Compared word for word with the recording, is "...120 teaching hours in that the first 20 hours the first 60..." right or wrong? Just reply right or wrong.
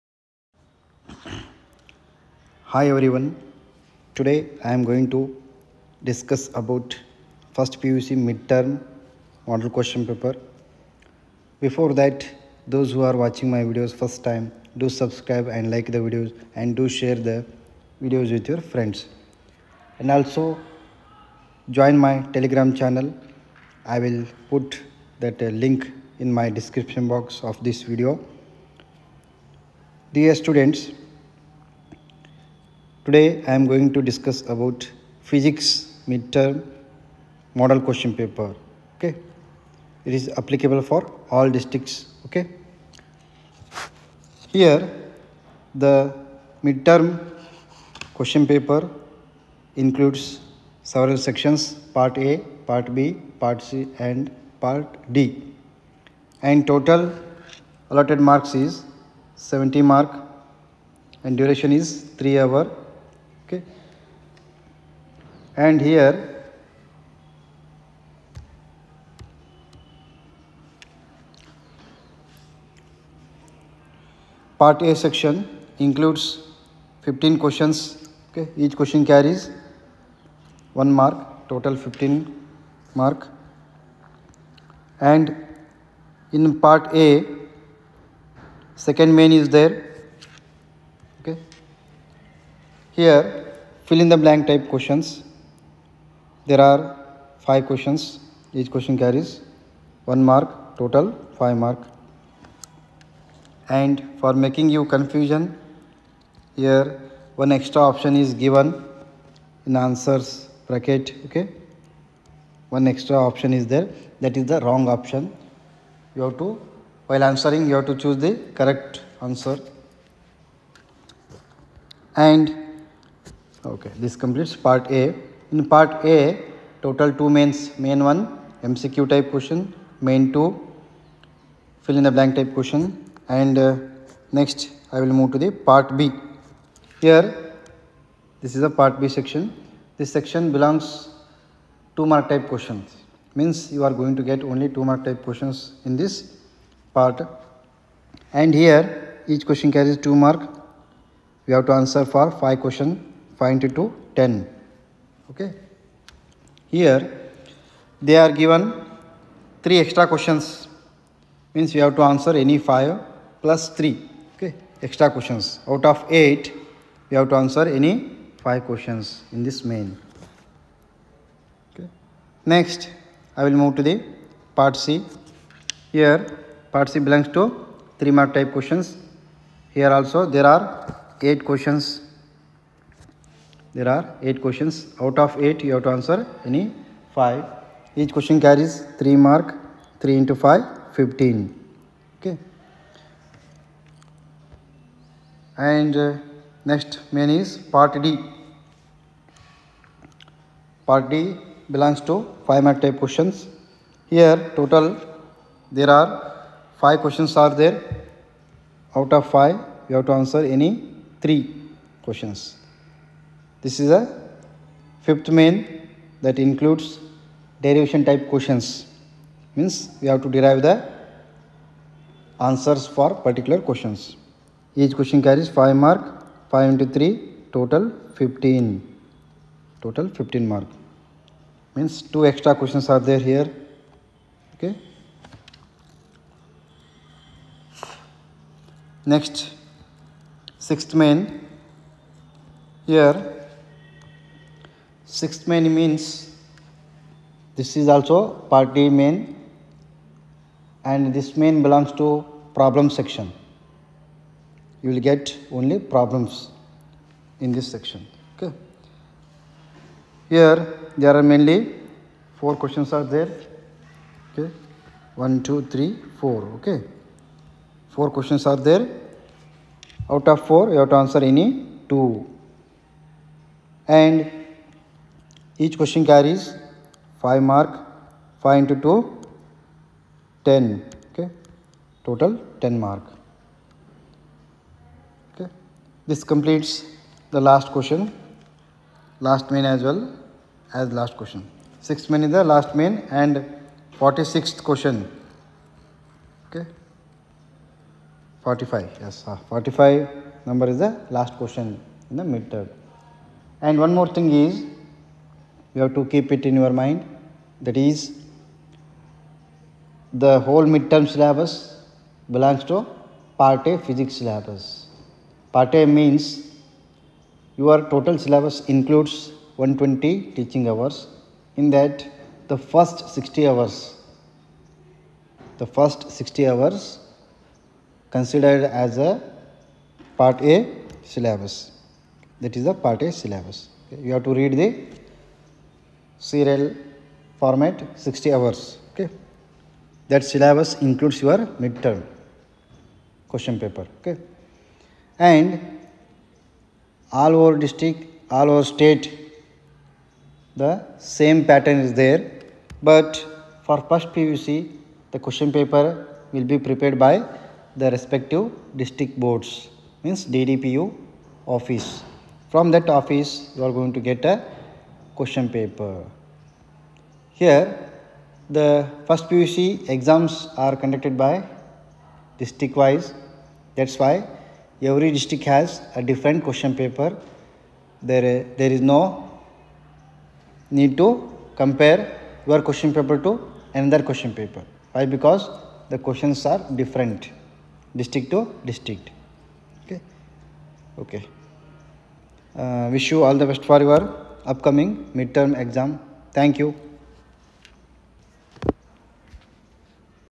wrong.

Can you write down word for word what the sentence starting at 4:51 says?
6 main is the last main and 46th question, okay, 45, yes, ah, 45 number is the last question in the midterm.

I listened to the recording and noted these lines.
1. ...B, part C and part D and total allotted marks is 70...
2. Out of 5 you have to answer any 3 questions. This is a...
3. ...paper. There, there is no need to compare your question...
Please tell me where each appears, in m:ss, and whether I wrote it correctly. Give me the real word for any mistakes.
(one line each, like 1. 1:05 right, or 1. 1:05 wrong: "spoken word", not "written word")
1. 0:52 right
2. 3:28 right
3. 6:16 right.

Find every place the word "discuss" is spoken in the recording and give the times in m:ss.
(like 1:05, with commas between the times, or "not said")
0:06, 0:34.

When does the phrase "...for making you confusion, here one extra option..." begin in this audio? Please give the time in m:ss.
1:44.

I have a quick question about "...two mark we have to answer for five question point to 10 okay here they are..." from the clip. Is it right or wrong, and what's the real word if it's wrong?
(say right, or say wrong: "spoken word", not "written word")
right.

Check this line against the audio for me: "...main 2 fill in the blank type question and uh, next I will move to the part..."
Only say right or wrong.
right.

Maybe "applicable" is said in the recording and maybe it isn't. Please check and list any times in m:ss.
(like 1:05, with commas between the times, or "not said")
0:40.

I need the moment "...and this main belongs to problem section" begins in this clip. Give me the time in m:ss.
4:10.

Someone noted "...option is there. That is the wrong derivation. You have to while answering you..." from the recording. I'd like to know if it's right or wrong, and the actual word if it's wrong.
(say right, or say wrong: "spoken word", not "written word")
wrong: "option", not "derivation".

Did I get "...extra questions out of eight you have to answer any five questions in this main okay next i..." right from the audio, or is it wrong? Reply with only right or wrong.
right.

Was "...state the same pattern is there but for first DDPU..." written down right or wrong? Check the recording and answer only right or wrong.
wrong.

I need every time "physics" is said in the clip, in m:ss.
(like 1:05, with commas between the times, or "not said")
0:35, 5:13.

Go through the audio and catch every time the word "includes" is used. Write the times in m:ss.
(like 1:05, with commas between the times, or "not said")
0:49, 1:15, 3:36, 5:18, 5:40.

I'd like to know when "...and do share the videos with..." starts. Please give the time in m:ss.
0:16.